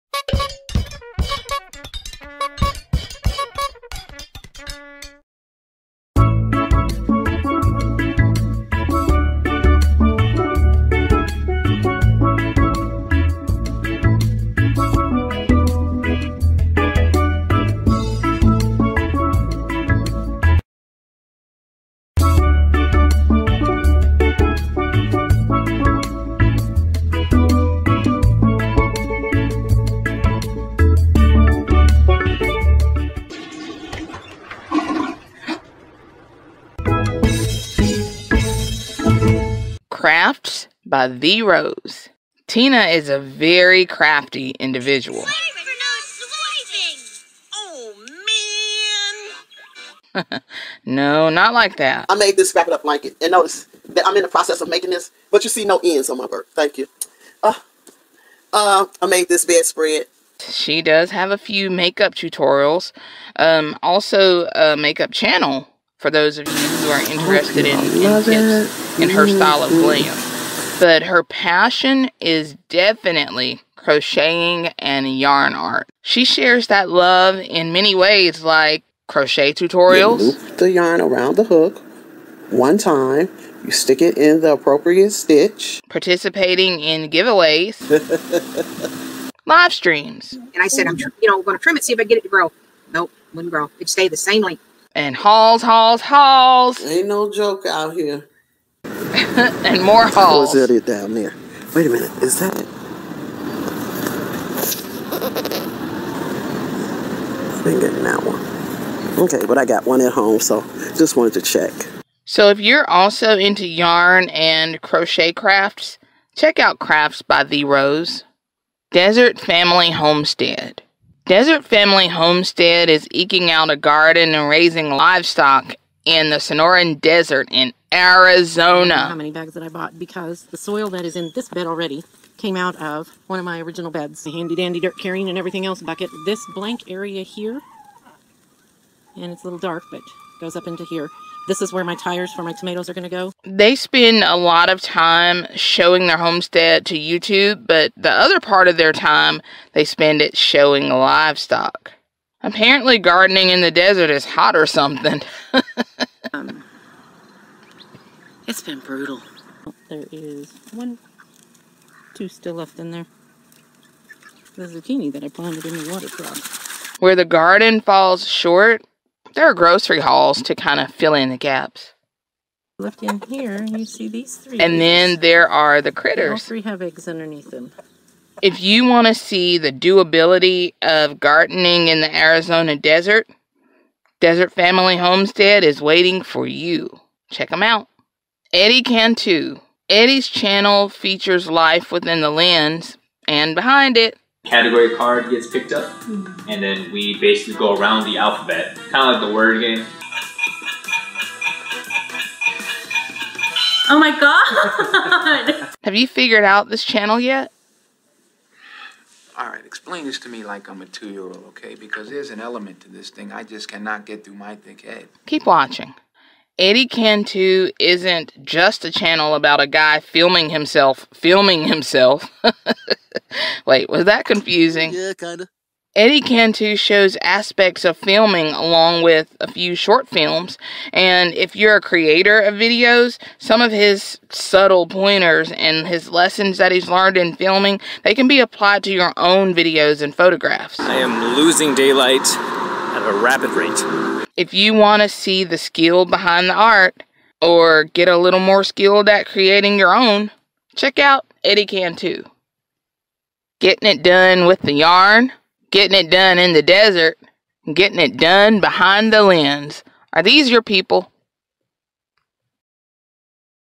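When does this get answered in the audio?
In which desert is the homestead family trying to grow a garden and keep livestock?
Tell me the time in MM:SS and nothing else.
02:06.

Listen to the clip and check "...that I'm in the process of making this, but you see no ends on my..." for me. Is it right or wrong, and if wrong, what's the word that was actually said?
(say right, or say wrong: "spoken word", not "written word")
right.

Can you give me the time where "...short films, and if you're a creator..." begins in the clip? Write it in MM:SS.
03:49.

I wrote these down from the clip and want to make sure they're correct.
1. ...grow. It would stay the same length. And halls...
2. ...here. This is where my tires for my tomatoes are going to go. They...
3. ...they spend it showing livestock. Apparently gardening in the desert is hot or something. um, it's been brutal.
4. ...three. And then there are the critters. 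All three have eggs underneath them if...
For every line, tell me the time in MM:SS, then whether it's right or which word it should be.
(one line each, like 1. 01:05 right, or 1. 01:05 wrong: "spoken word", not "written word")
1. 01:33 wrong: "hauls", not "halls"
2. 02:20 right
3. 02:29 right
4. 02:54 right.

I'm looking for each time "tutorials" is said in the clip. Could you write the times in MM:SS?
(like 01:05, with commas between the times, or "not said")
01:02, 01:19.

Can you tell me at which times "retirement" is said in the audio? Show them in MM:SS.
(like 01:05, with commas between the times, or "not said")
not said.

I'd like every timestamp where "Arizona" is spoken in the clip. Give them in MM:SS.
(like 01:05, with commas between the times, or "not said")
02:07, 03:02.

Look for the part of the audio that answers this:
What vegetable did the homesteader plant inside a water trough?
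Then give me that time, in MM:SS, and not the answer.
02:44.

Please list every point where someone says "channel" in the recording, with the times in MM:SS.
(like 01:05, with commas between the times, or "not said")
01:05, 03:10, 03:26, 03:38.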